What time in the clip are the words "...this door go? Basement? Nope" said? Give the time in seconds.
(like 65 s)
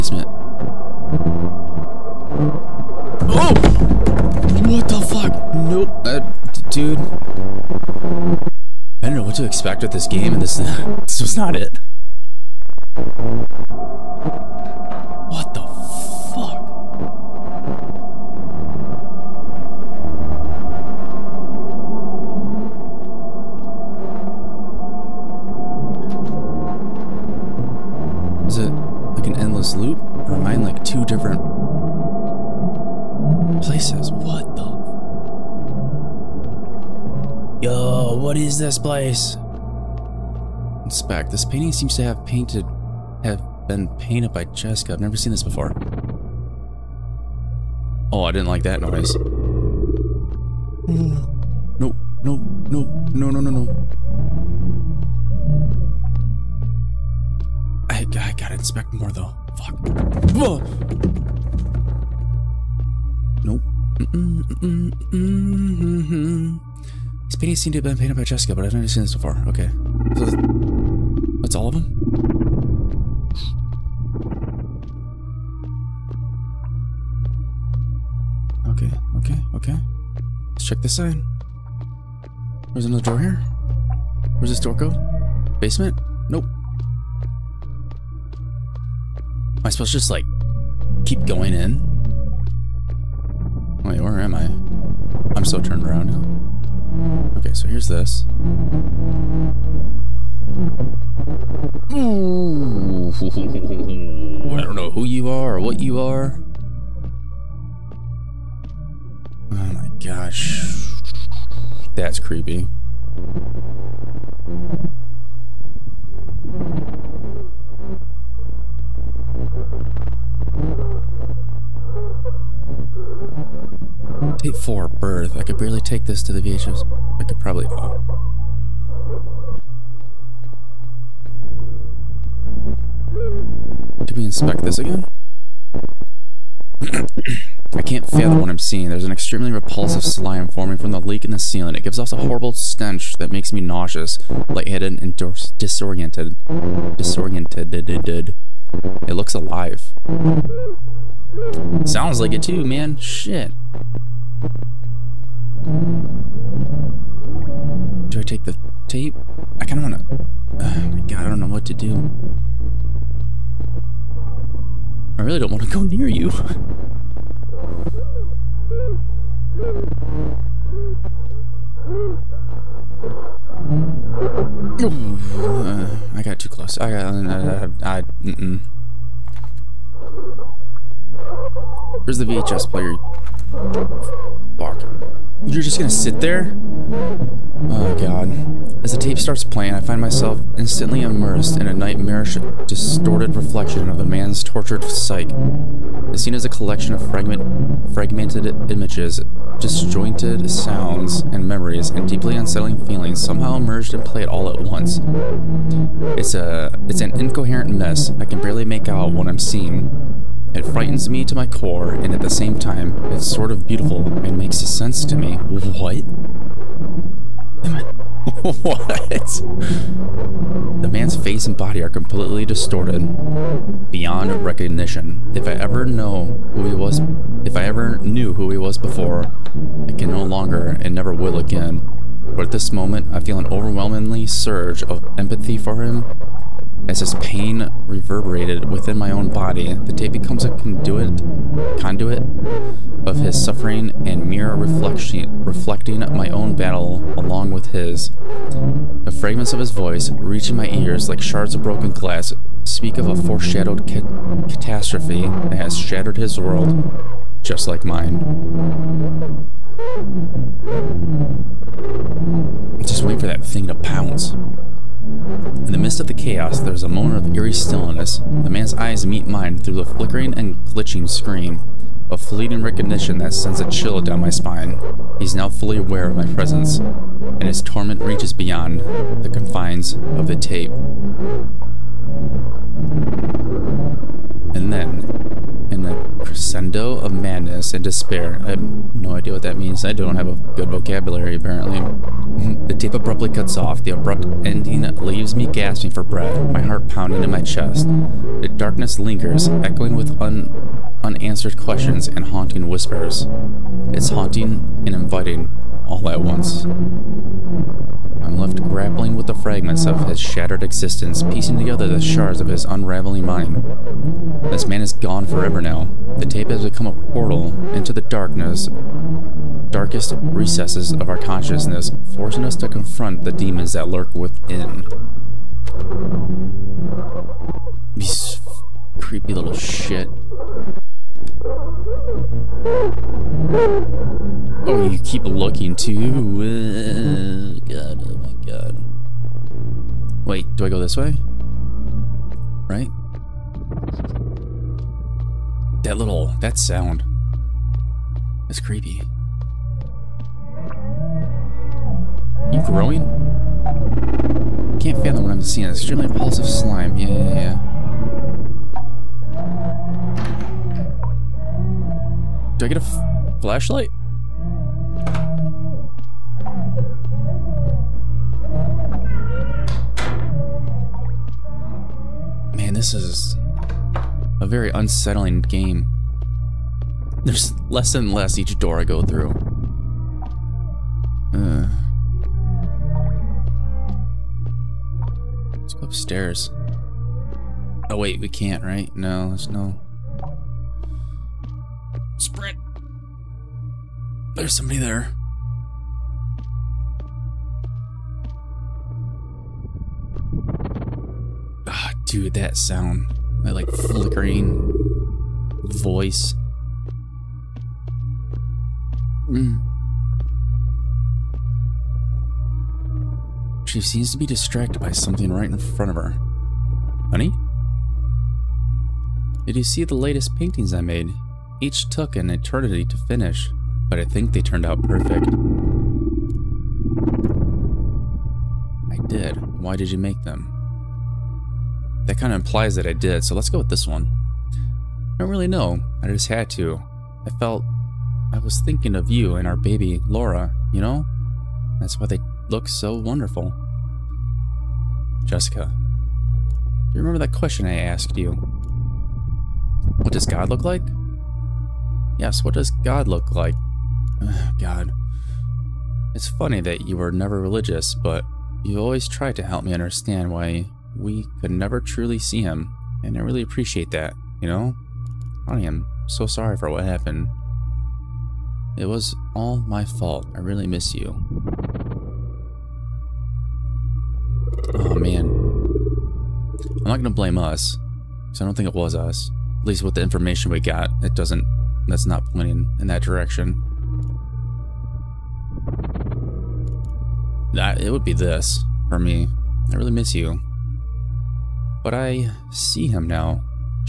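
84 s.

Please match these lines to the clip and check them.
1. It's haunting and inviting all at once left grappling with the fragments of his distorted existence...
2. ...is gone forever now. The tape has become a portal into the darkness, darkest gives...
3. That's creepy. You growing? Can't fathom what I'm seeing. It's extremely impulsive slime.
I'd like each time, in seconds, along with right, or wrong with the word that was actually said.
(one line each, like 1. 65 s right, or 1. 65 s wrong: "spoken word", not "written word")
1. 303 s wrong: "shattered", not "distorted"
2. 314 s wrong: "recesses", not "gives"
3. 348 s right.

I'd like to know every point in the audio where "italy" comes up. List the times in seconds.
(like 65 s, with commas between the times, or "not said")
not said.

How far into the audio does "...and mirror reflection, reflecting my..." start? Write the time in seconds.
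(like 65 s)
244 s.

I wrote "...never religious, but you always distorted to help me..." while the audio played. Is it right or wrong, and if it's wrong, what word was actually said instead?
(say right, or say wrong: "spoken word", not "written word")
wrong: "tried", not "distorted".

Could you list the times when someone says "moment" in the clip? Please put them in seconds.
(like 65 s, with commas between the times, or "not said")
232 s, 266 s.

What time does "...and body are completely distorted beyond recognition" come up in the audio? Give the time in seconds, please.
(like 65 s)
221 s.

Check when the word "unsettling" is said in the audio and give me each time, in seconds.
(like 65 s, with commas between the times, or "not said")
202 s, 374 s.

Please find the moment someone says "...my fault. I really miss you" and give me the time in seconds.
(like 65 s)
469 s.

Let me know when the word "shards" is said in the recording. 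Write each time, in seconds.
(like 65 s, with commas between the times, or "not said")
251 s, 312 s.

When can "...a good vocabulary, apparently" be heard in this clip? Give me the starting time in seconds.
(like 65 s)
290 s.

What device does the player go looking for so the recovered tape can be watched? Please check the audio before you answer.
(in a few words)
VHS player.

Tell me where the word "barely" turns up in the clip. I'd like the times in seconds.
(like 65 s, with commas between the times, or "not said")
125 s, 208 s.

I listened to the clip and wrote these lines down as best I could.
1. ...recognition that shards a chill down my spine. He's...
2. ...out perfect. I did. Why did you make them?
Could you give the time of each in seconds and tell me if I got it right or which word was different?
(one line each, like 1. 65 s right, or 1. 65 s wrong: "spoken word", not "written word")
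1. 272 s wrong: "sends", not "shards"
2. 424 s right.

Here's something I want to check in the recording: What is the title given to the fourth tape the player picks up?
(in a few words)
Birth.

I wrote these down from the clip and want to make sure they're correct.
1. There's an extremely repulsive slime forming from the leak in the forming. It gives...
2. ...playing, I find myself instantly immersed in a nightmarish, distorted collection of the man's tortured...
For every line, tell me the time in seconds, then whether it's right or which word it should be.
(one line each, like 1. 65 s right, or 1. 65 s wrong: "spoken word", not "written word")
1. 138 s wrong: "ceiling", not "forming"
2. 189 s wrong: "reflection", not "collection".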